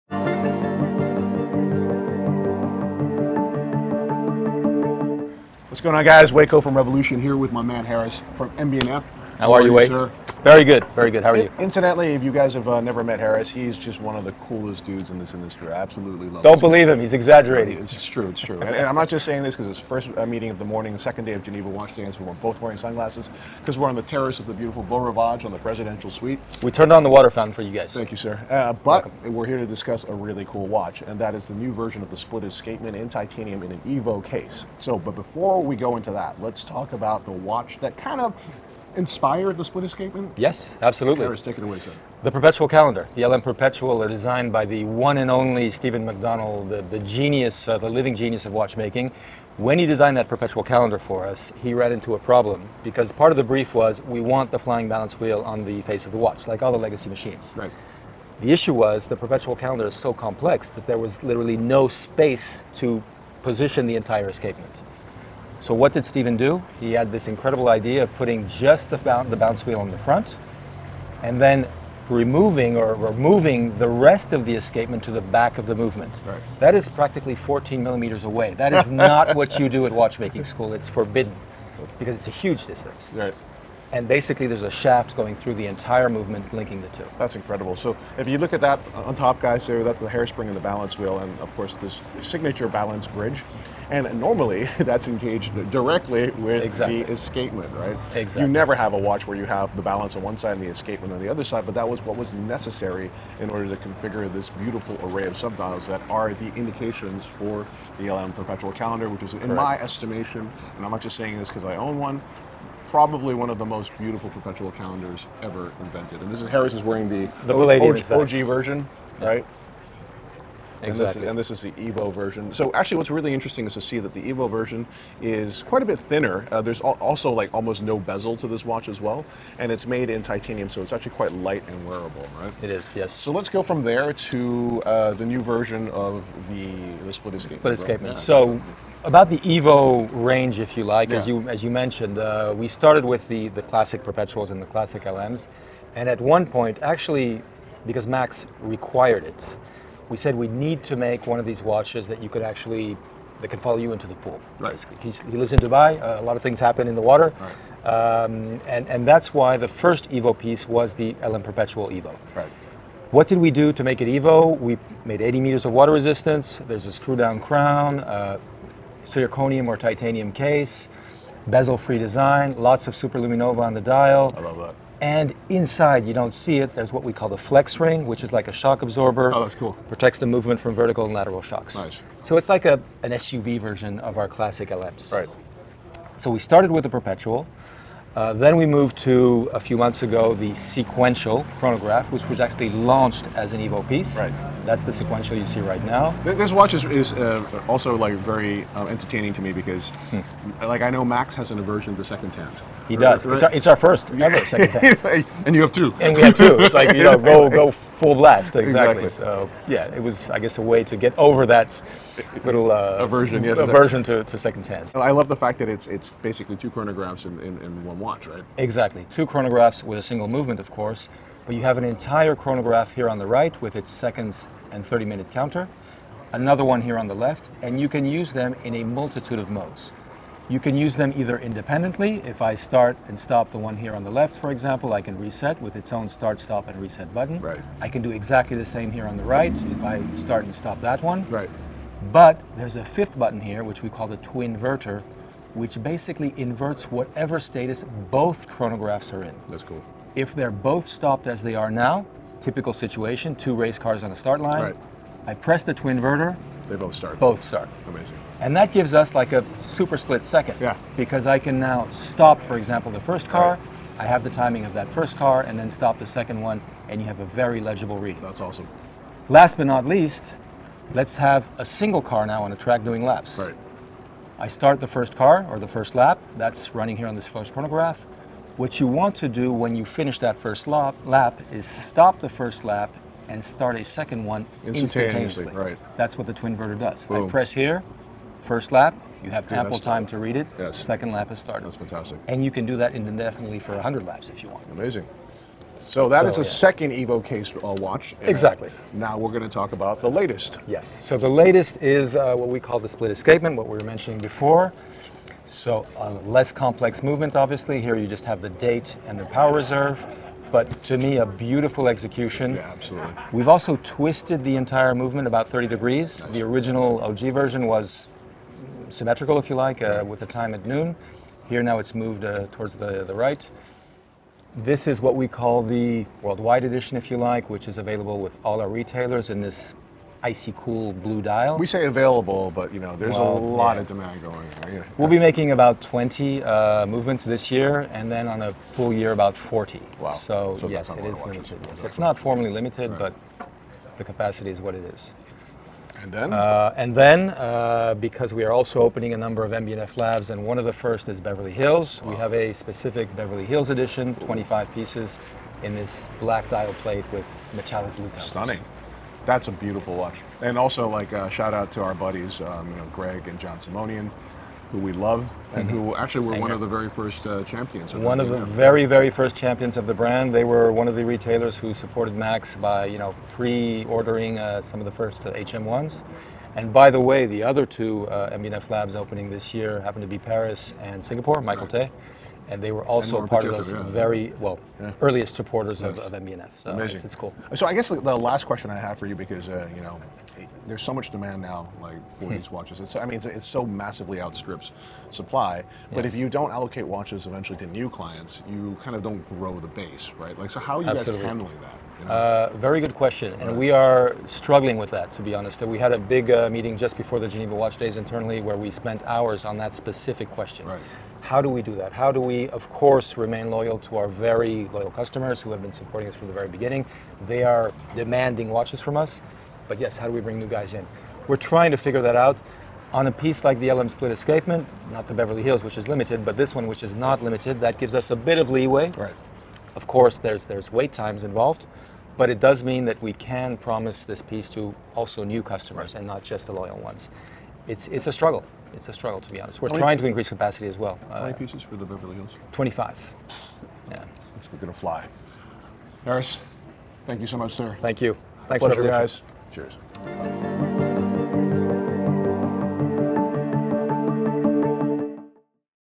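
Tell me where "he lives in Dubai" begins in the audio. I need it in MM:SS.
02:35.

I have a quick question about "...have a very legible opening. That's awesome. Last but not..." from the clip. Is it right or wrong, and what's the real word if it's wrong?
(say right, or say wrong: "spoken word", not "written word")
wrong: "reading", not "opening".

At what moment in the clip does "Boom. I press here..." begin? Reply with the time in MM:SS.
04:47.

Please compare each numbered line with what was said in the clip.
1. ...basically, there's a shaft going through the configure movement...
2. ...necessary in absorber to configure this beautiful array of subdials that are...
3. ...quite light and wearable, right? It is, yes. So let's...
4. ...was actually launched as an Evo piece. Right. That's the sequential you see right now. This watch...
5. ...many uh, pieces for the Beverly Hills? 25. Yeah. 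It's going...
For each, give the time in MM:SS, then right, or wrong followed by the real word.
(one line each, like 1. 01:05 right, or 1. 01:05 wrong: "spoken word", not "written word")
1. 01:24 wrong: "entire", not "configure"
2. 01:42 wrong: "order", not "absorber"
3. 02:11 right
4. 03:12 right
5. 07:21 right.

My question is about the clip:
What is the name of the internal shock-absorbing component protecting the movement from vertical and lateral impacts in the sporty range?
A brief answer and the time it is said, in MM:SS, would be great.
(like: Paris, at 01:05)
flex ring, at 02:57.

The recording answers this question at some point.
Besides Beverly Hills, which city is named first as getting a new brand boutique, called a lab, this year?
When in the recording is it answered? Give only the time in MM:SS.
06:20.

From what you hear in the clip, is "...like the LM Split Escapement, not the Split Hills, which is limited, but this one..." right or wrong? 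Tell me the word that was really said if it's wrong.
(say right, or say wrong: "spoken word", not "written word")
wrong: "Beverly", not "Split".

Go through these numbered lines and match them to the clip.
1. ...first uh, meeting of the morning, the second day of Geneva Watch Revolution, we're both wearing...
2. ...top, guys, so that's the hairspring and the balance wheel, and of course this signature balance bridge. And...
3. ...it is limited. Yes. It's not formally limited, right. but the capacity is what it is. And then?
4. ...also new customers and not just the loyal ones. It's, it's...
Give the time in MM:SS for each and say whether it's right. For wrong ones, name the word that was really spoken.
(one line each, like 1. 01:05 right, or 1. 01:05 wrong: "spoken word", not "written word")
1. 00:19 wrong: "Days", not "Revolution"
2. 01:29 right
3. 05:40 right
4. 07:14 right.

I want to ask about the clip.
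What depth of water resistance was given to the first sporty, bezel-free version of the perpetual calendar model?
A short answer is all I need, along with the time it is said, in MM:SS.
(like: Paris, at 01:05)
80 meters, at 02:45.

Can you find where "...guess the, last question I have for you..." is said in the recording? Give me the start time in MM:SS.
06:27.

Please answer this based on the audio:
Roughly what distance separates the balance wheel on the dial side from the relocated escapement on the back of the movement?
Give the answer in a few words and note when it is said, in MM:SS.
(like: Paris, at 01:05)
14 millimeters, at 01:17.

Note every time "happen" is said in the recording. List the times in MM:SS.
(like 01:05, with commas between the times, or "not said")
02:36, 06:19.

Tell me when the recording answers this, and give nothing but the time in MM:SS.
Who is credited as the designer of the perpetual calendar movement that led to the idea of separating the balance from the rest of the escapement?
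00:45.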